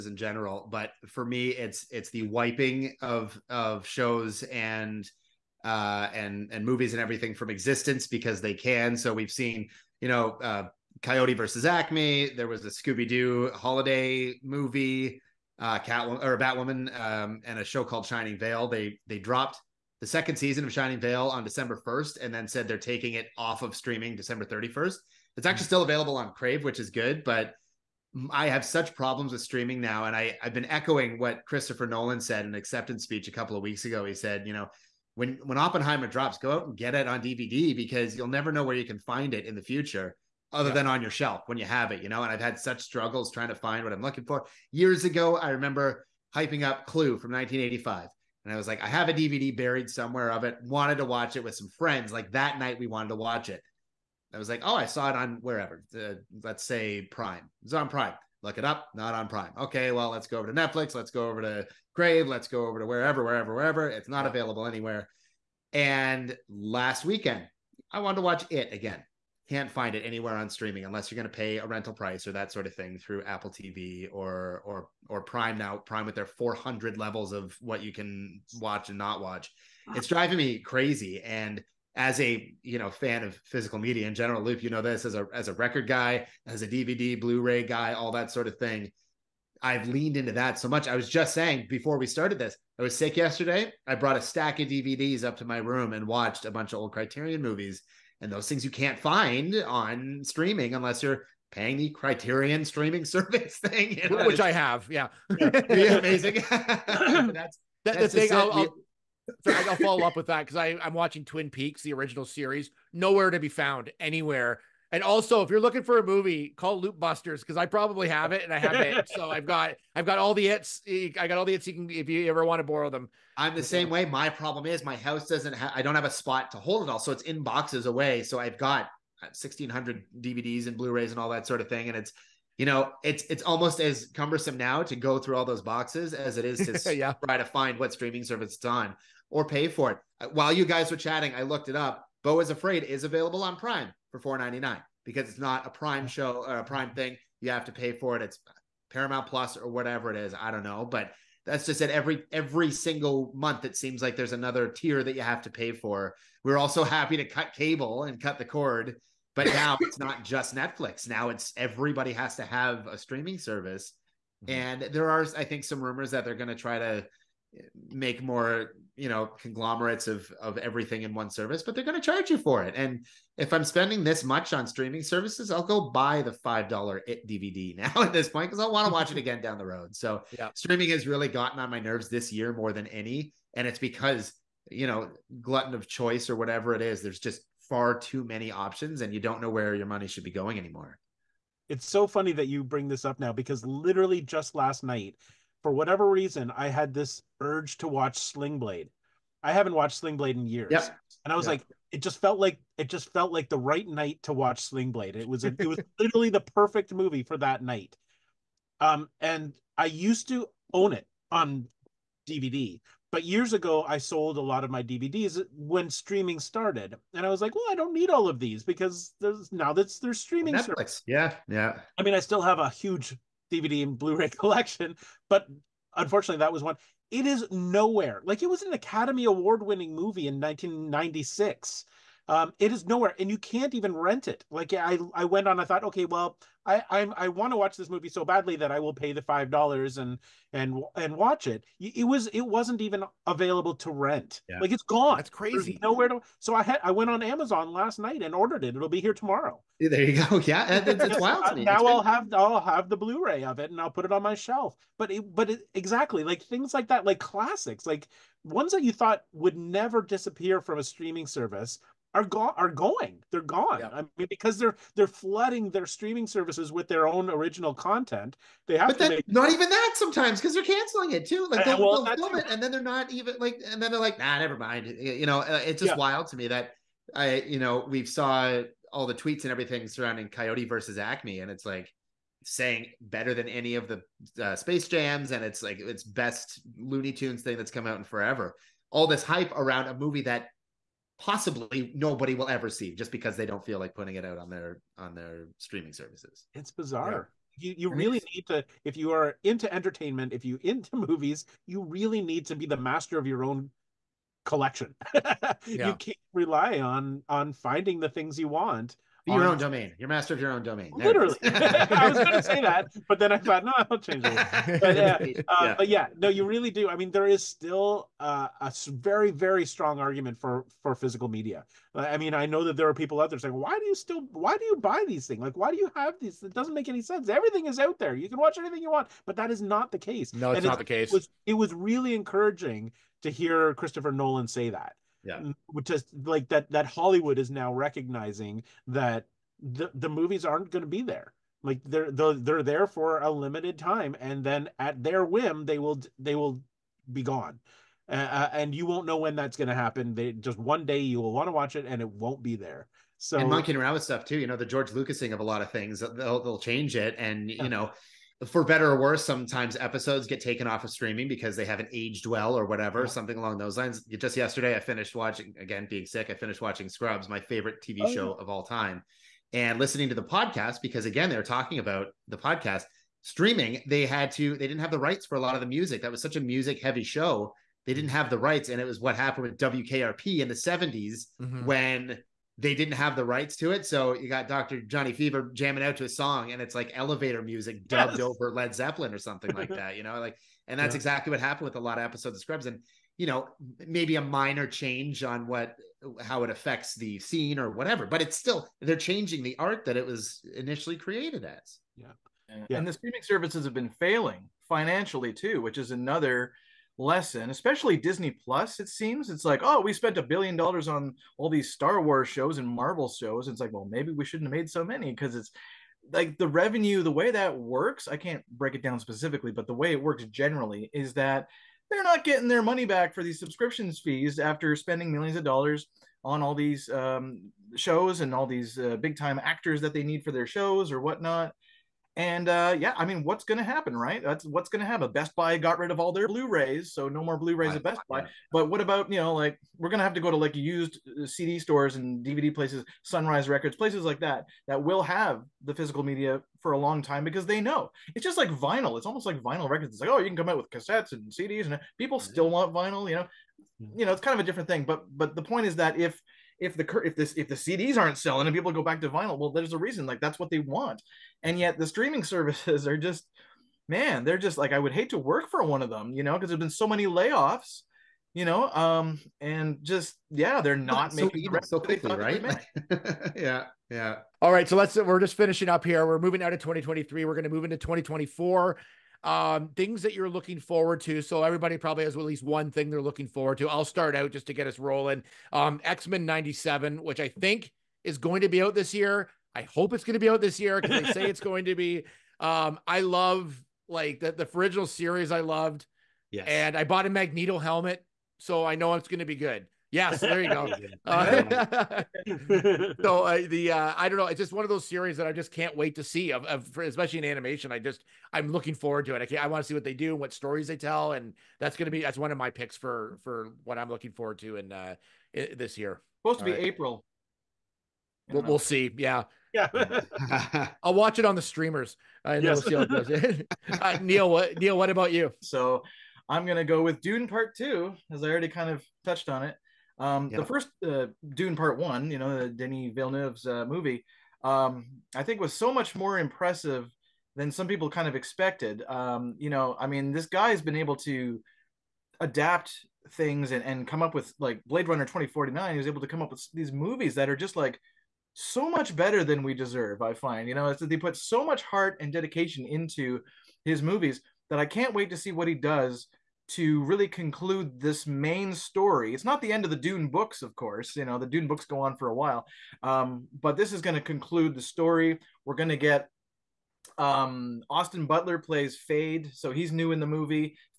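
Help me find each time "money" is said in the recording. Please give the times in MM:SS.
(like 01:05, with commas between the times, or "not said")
03:09, 07:02.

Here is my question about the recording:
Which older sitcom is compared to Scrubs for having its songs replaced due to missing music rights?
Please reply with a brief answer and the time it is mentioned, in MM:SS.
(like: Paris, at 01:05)
WKRP, at 06:19.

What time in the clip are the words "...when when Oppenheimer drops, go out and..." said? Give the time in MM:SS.
00:35.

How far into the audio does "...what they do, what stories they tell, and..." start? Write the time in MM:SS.
08:29.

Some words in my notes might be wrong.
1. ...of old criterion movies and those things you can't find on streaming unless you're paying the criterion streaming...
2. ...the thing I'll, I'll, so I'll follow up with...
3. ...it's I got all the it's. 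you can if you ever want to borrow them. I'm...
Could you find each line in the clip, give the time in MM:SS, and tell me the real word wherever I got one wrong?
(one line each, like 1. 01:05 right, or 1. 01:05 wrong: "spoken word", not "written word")
1. 01:36 right
2. 01:48 right
3. 02:00 right.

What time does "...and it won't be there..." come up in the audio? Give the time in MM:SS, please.
05:51.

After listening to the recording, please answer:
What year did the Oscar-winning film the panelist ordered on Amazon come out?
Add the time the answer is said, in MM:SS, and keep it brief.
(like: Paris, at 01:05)
1996, at 03:50.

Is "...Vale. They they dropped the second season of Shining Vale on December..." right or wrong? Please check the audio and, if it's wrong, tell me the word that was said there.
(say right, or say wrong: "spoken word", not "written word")
right.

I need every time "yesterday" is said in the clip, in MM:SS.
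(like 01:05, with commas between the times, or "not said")
01:33, 06:04.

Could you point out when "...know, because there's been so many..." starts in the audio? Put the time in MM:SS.
07:46.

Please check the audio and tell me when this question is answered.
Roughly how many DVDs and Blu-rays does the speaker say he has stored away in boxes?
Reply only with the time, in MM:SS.
02:09.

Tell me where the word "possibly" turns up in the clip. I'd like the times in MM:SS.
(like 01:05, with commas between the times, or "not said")
04:51.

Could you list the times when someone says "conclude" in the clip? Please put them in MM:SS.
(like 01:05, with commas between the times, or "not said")
09:17, 09:23.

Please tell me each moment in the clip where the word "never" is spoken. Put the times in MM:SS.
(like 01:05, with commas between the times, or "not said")
00:38, 04:19, 04:34.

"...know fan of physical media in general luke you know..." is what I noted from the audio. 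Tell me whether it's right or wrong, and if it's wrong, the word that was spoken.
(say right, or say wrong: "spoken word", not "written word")
right.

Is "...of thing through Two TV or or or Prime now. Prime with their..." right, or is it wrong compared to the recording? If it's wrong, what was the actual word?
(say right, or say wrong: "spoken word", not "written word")
wrong: "Apple", not "Two".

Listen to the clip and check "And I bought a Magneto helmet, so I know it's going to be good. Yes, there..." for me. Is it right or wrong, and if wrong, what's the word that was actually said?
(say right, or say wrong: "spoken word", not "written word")
right.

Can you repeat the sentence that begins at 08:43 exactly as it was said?
uh, Neil, what Neil, what about you?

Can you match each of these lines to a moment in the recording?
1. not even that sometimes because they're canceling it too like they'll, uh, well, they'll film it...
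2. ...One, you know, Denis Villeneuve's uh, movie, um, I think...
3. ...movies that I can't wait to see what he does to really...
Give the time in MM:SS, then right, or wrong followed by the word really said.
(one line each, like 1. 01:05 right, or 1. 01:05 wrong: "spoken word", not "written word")
1. 04:29 right
2. 08:51 right
3. 09:13 right.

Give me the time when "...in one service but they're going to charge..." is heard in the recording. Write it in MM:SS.
02:51.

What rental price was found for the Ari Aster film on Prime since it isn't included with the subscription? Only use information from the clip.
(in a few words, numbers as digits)
$4.99.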